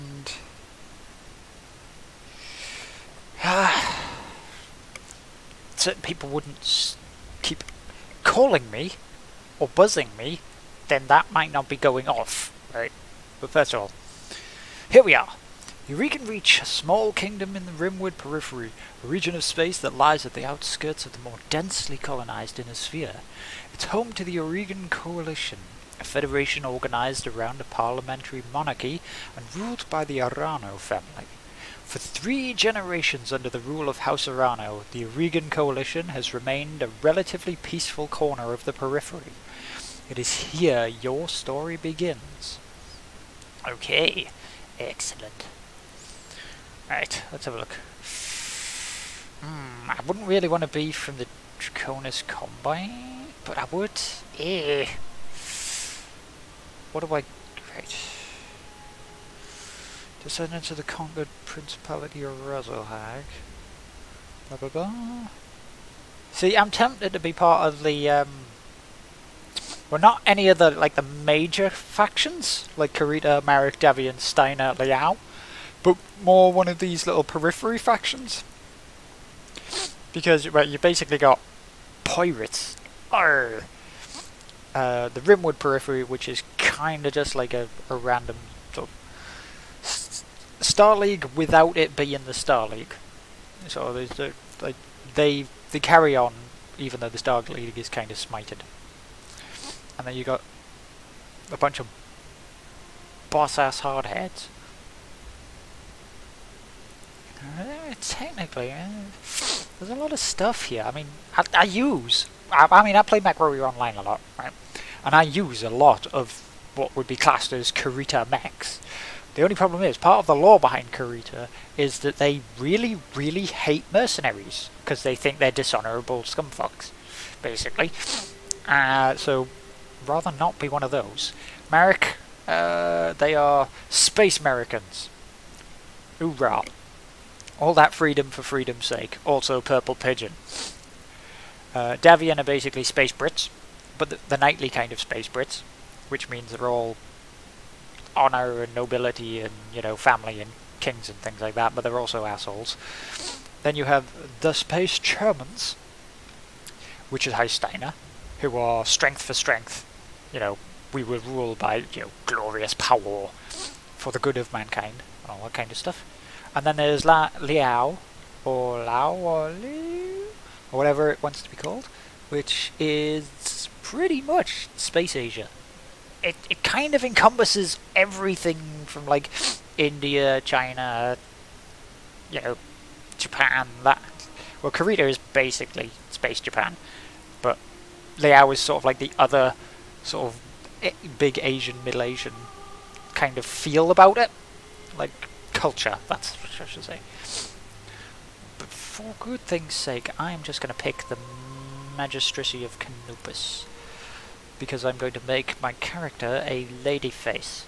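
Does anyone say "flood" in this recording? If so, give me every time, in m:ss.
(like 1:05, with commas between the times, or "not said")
not said.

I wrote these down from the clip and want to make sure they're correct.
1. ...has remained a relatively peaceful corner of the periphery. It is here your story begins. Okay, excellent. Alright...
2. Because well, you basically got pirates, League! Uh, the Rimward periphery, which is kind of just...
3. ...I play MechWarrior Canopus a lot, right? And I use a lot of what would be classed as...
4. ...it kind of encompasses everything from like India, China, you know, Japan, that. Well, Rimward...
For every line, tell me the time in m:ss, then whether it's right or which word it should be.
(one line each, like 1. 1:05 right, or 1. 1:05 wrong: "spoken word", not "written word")
1. 0:36 right
2. 1:20 wrong: "Arr", not "League"
3. 1:52 wrong: "Online", not "Canopus"
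4. 2:56 wrong: "Kurita", not "Rimward".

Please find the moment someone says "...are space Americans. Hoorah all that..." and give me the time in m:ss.
2:13.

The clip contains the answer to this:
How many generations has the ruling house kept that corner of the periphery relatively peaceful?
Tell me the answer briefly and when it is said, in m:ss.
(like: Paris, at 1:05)
3, at 0:31.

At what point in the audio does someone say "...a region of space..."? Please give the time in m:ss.
0:19.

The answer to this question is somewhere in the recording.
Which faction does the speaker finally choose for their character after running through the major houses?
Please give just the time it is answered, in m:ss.
3:21.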